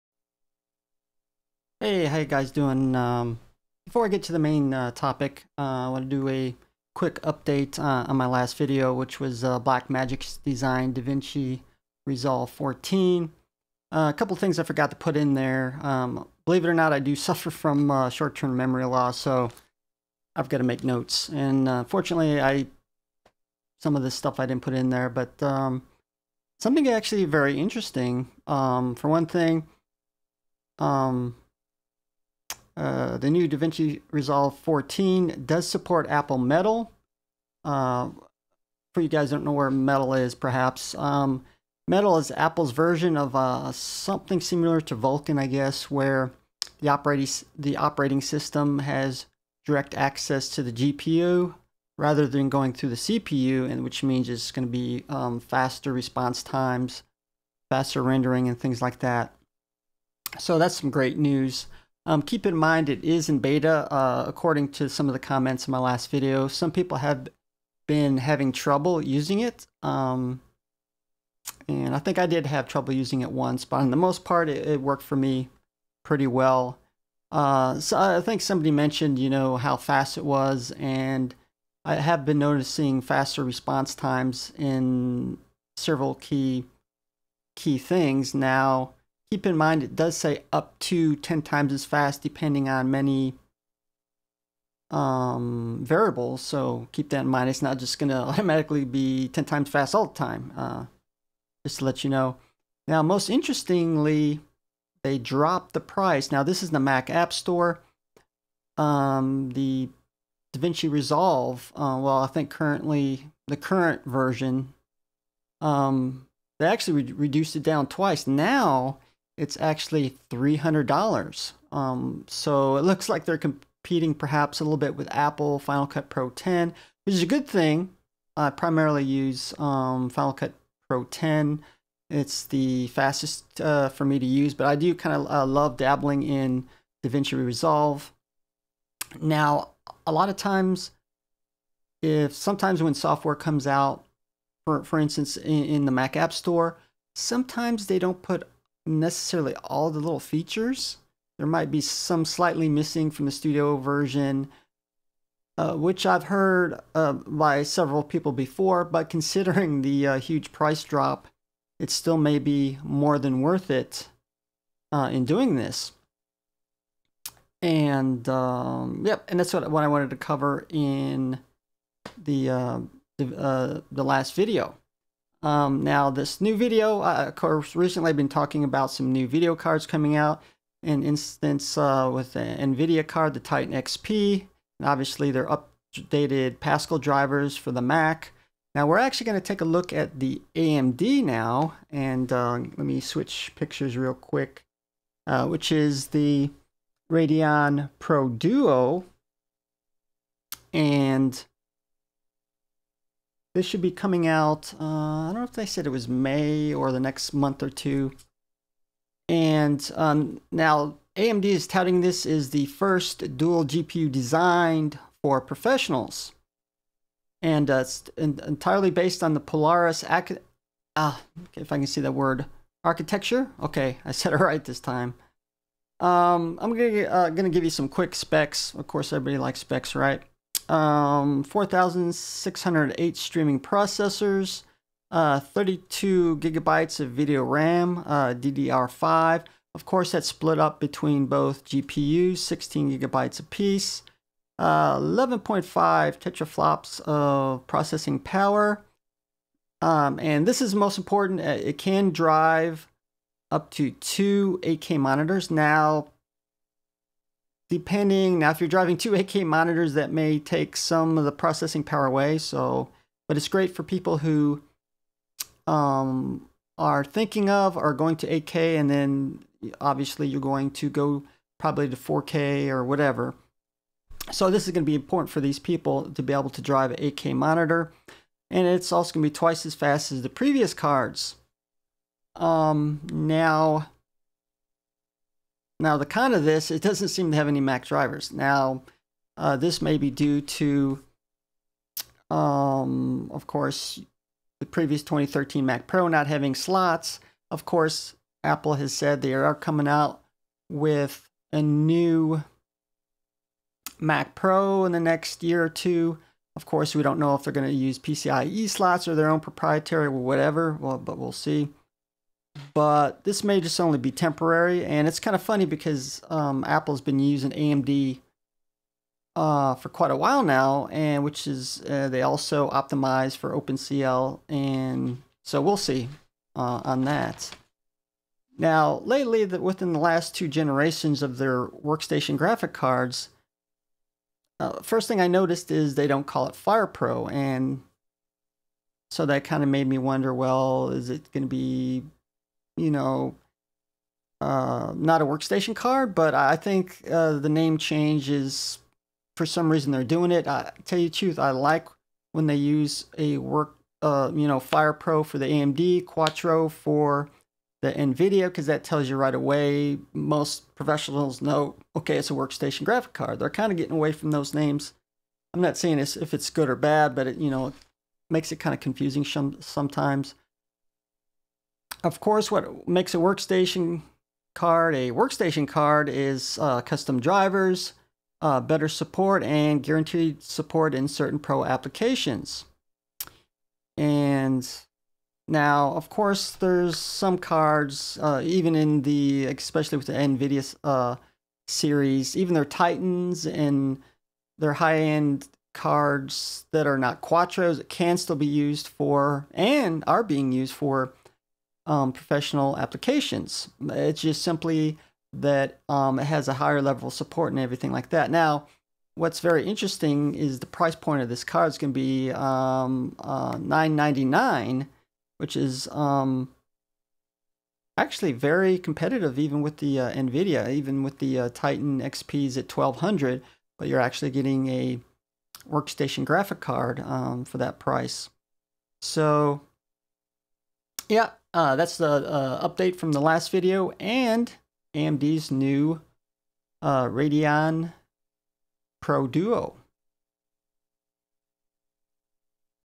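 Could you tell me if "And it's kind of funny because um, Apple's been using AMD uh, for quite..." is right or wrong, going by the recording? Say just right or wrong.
right.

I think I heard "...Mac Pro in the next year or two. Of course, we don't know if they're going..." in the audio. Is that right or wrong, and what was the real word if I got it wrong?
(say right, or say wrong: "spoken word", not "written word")
right.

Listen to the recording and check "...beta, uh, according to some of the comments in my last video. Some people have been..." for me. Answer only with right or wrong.
right.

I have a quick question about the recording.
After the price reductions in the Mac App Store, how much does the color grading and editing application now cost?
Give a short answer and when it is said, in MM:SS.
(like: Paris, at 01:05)
$300, at 02:00.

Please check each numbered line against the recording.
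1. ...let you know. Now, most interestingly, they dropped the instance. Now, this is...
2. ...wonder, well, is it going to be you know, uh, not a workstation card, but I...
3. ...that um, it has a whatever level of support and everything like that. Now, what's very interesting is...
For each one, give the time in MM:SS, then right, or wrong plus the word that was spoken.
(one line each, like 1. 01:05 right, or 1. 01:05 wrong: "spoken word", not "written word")
1. 01:41 wrong: "price", not "instance"
2. 05:39 right
3. 06:45 wrong: "higher", not "whatever".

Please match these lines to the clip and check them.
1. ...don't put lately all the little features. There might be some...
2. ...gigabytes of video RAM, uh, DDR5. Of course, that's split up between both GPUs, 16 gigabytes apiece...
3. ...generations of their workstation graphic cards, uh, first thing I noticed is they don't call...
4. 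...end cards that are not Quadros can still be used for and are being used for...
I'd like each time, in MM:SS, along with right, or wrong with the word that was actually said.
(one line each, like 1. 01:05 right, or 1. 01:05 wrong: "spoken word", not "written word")
1. 02:27 wrong: "necessarily", not "lately"
2. 03:56 right
3. 05:30 right
4. 06:34 right.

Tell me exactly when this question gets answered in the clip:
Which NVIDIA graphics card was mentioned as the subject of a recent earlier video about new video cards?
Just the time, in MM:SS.
03:03.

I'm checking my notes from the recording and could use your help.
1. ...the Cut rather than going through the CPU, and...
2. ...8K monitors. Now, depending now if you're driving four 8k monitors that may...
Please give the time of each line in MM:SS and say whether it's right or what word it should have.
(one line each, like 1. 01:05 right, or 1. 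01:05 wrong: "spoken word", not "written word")
1. 00:50 wrong: "GPU", not "Cut"
2. 04:14 wrong: "two", not "four".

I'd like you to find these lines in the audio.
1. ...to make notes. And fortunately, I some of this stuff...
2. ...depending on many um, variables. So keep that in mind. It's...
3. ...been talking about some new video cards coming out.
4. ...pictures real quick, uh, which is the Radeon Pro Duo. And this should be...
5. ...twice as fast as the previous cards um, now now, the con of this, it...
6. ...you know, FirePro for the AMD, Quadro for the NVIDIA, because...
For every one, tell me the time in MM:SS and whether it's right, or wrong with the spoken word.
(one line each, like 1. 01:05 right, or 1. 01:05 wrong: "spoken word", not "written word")
1. 00:20 right
2. 01:32 right
3. 02:58 right
4. 03:13 right
5. 04:39 right
6. 05:54 right.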